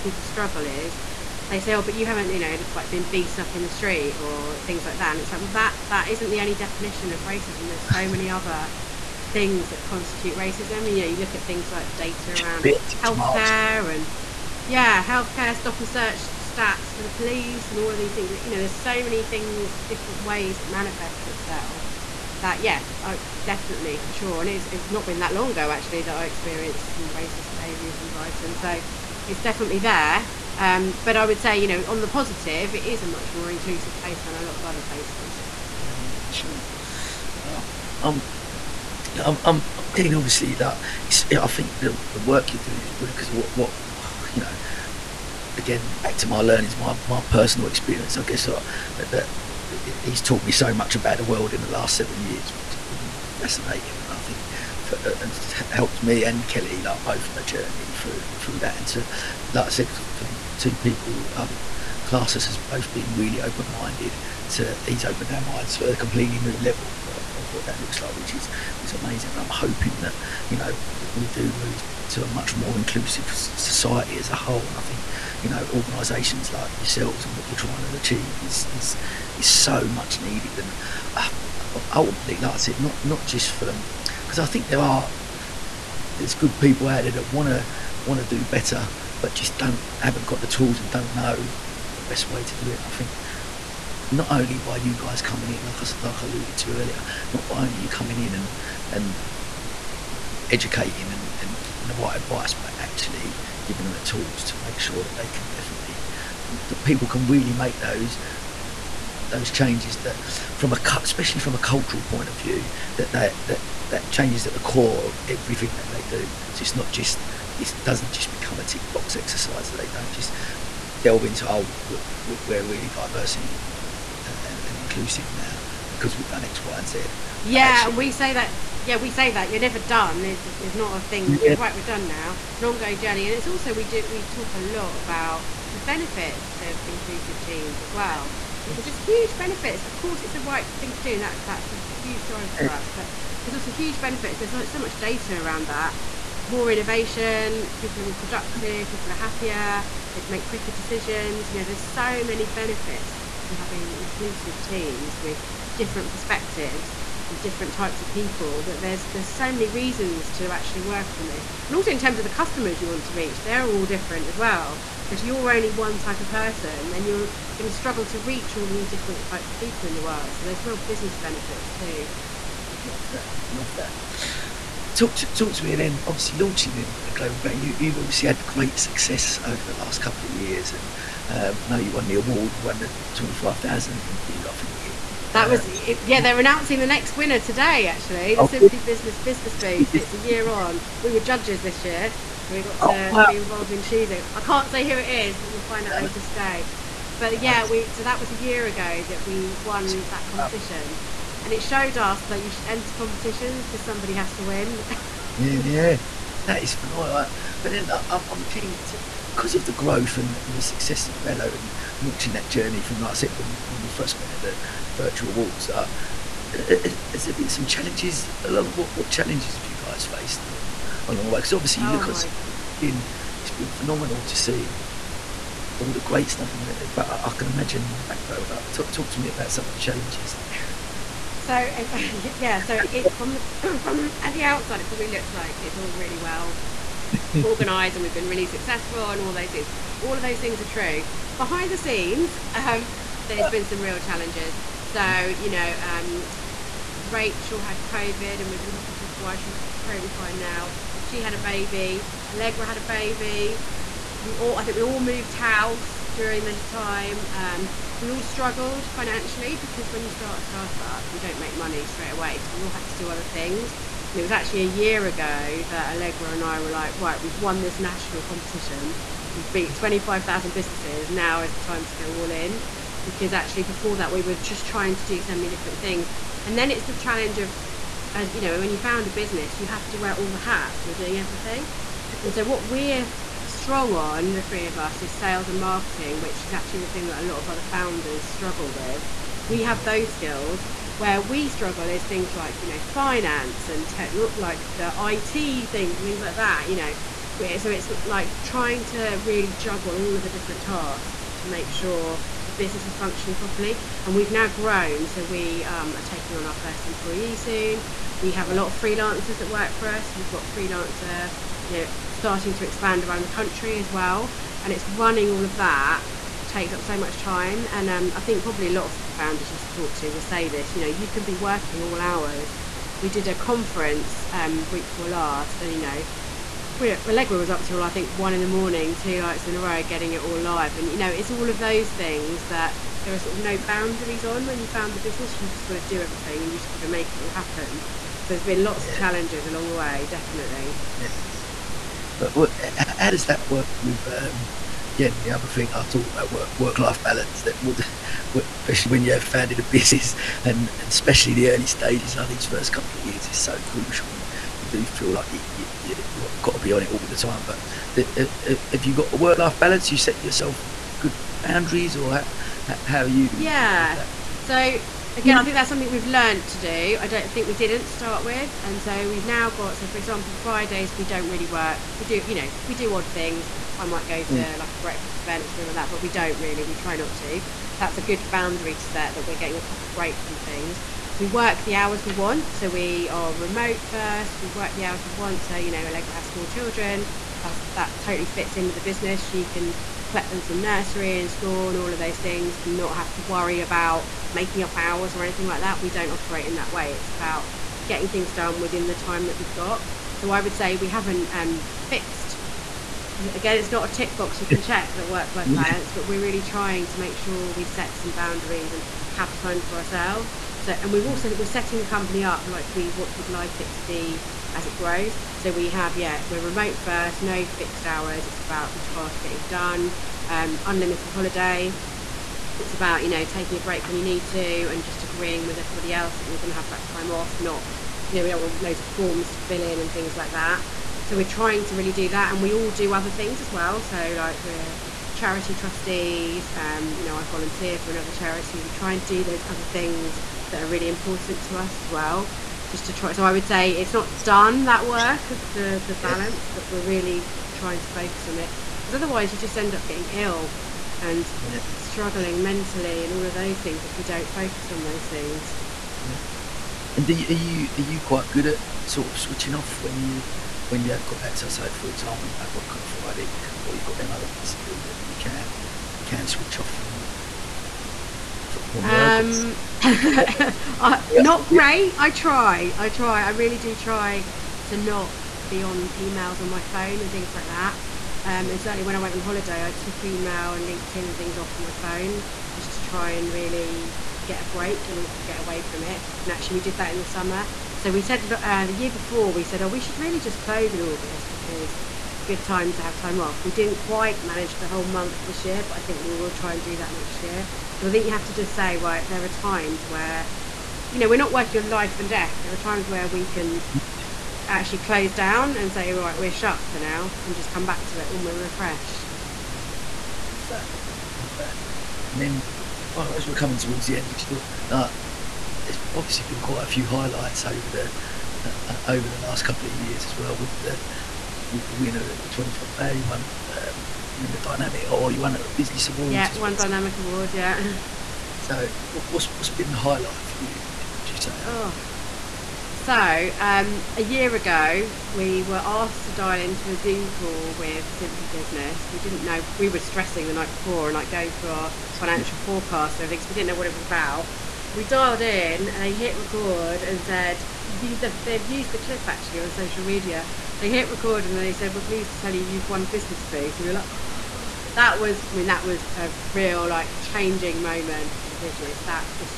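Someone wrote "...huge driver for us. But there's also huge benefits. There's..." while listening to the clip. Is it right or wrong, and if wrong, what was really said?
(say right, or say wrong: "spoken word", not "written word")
right.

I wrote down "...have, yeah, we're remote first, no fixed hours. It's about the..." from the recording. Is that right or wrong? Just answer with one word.
right.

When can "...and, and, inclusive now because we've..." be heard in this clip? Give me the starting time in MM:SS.
02:04.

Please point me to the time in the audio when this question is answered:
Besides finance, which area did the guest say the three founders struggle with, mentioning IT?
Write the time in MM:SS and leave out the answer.
04:53.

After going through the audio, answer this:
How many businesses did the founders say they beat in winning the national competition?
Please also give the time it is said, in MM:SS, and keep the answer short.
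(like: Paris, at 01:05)
25,000, at 04:29.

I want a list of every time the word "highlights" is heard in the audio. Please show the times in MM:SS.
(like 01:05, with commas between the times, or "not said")
08:36, 08:49.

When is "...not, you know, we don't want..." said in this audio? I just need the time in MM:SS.
07:07.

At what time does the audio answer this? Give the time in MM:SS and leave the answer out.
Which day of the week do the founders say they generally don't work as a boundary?
06:10.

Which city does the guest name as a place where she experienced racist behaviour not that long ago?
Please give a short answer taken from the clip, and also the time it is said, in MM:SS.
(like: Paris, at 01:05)
Brighton, at 00:28.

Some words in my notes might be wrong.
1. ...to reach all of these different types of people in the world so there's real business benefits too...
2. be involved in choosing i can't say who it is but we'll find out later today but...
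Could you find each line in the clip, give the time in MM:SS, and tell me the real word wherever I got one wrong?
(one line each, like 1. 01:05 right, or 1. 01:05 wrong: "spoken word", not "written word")
1. 02:48 right
2. 03:13 right.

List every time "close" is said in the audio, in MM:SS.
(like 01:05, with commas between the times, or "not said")
08:10, 08:24.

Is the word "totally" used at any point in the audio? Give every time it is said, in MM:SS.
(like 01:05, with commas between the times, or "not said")
04:09, 06:28.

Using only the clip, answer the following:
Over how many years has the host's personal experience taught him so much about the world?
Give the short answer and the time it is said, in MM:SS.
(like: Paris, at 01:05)
7, at 00:51.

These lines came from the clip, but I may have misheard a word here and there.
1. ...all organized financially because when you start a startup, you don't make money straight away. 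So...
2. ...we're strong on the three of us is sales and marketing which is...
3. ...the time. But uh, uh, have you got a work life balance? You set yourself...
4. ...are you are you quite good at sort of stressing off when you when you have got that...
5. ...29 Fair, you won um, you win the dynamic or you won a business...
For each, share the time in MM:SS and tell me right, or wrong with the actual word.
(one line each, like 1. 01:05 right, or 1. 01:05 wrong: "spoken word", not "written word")
1. 04:18 wrong: "struggled", not "organized"
2. 04:42 right
3. 05:57 right
4. 07:37 wrong: "switching", not "stressing"
5. 08:42 wrong: "25", not "29".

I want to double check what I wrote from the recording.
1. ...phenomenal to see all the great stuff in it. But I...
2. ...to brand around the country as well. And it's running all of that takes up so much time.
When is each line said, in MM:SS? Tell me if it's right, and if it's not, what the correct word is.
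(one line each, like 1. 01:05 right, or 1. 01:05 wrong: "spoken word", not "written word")
1. 03:43 right
2. 05:12 wrong: "expand", not "brand".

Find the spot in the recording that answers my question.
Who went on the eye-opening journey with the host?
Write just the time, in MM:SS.
00:56.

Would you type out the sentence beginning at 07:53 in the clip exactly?
I really do try to not be on emails on my phone and things like that.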